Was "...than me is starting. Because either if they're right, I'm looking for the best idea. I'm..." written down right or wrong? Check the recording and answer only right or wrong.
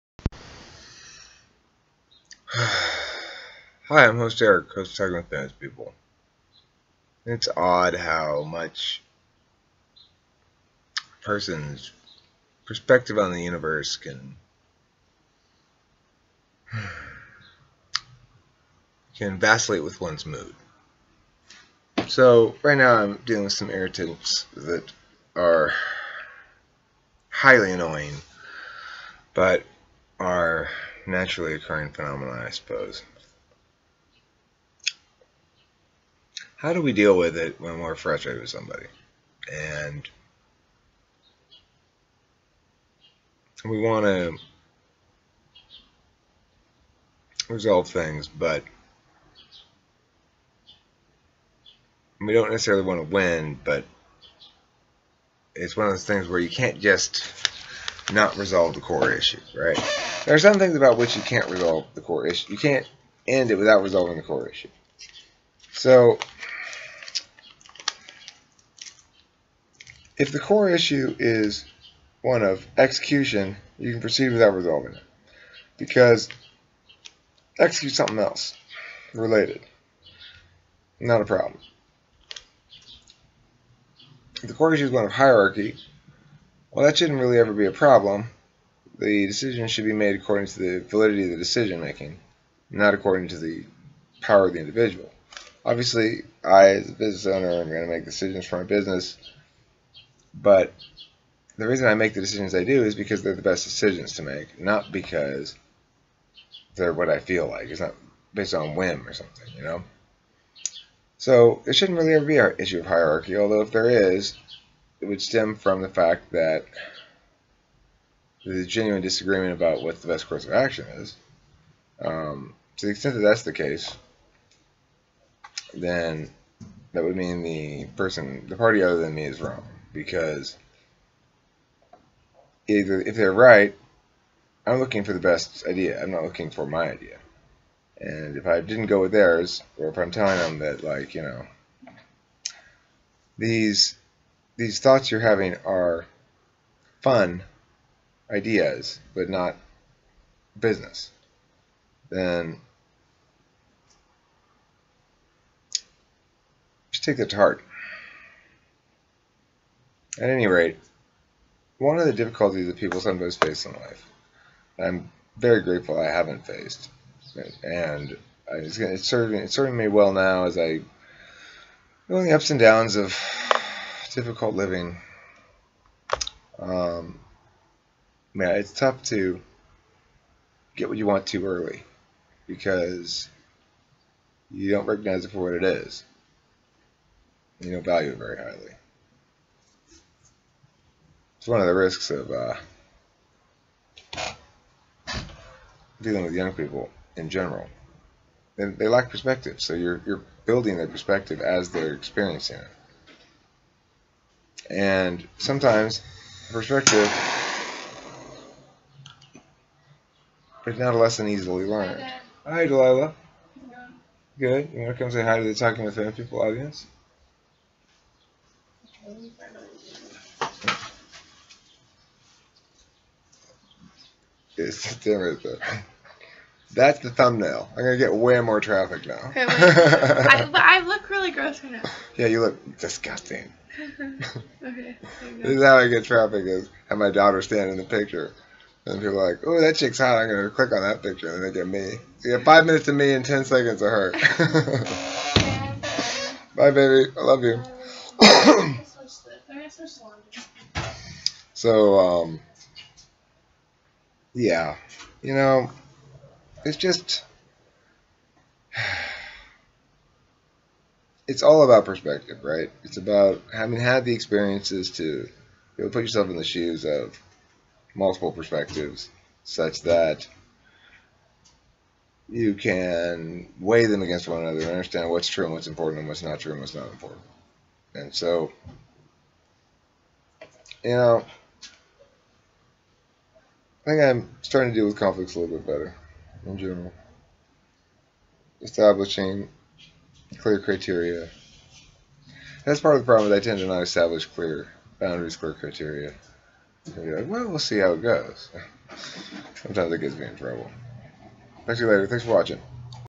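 wrong.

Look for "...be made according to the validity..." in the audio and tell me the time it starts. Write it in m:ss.
1:29.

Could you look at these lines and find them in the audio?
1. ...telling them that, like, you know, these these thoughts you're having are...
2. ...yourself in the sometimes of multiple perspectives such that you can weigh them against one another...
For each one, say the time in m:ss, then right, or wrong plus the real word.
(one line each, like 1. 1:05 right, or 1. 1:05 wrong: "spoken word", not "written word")
1. 2:20 right
2. 4:26 wrong: "shoes", not "sometimes".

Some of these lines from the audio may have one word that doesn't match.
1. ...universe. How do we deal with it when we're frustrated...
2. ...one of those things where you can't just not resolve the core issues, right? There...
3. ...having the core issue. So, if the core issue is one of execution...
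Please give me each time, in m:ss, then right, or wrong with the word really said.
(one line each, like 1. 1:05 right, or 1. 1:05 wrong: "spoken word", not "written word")
1. 0:32 wrong: "suppose", not "universe"
2. 0:55 right
3. 1:03 wrong: "resolving", not "having".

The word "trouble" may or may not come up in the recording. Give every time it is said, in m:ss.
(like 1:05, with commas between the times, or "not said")
5:00.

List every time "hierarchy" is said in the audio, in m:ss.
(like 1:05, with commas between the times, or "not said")
1:25, 1:52.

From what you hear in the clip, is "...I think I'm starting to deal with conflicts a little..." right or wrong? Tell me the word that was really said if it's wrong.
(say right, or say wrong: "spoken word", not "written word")
right.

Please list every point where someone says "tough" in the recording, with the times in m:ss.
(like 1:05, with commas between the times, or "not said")
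2:58.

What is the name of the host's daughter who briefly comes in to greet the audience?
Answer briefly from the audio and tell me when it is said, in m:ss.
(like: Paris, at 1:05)
Delilah, at 3:32.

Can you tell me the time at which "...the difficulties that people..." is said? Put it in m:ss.
2:42.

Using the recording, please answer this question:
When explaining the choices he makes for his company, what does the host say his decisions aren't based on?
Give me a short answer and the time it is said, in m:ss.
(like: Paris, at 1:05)
whim, at 1:48.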